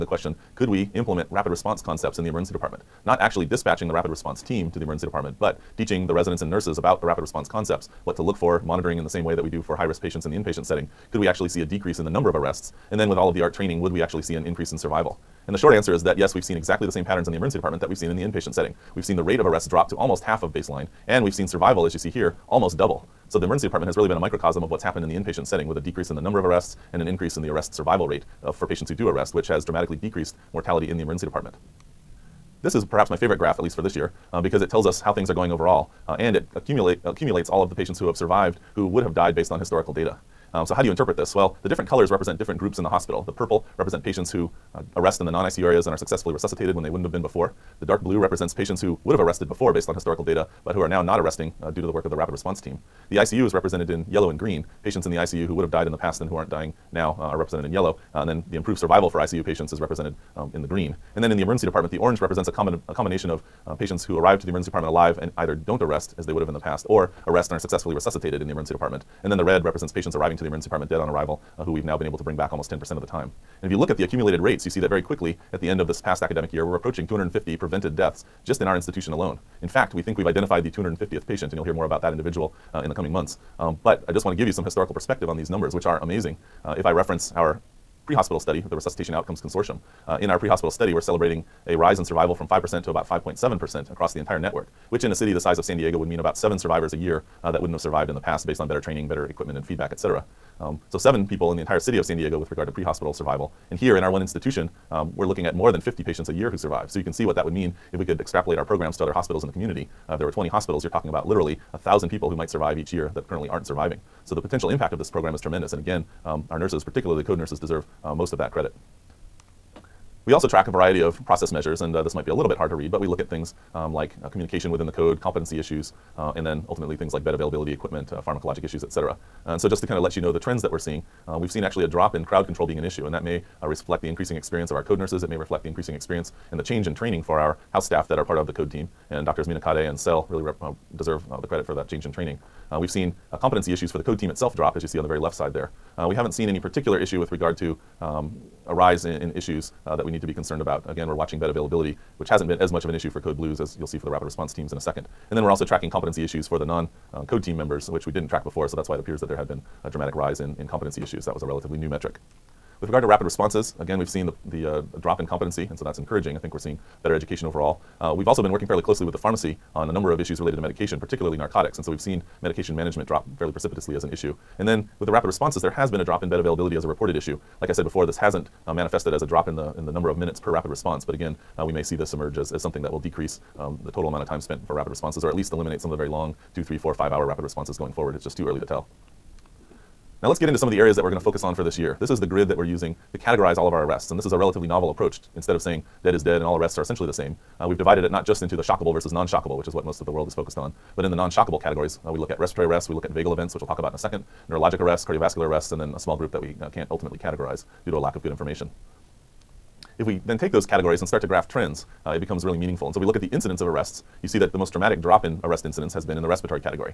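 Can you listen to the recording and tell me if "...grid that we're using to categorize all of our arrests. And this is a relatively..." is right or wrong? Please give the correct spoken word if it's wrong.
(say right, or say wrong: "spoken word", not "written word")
right.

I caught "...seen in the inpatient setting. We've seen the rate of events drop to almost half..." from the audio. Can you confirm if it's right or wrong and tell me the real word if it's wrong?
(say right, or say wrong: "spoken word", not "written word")
wrong: "arrests", not "events".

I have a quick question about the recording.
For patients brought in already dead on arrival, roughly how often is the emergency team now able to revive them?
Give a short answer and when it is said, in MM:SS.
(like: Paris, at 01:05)
almost 10%, at 01:12.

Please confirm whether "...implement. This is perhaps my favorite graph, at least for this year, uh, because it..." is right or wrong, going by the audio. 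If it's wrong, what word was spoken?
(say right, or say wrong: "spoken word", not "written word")
wrong: "department", not "implement".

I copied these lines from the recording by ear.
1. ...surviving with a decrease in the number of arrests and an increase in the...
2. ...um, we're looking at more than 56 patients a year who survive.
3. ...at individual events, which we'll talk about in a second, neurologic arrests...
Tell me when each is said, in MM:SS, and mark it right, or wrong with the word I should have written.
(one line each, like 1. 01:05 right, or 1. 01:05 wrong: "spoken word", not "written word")
1. 00:25 wrong: "setting", not "surviving"
2. 01:44 wrong: "50", not "56"
3. 03:23 wrong: "vagal", not "individual".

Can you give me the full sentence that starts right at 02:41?
That was a relatively new metric.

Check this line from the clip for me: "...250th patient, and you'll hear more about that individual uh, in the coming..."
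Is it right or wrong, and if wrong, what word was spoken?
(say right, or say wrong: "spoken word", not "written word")
right.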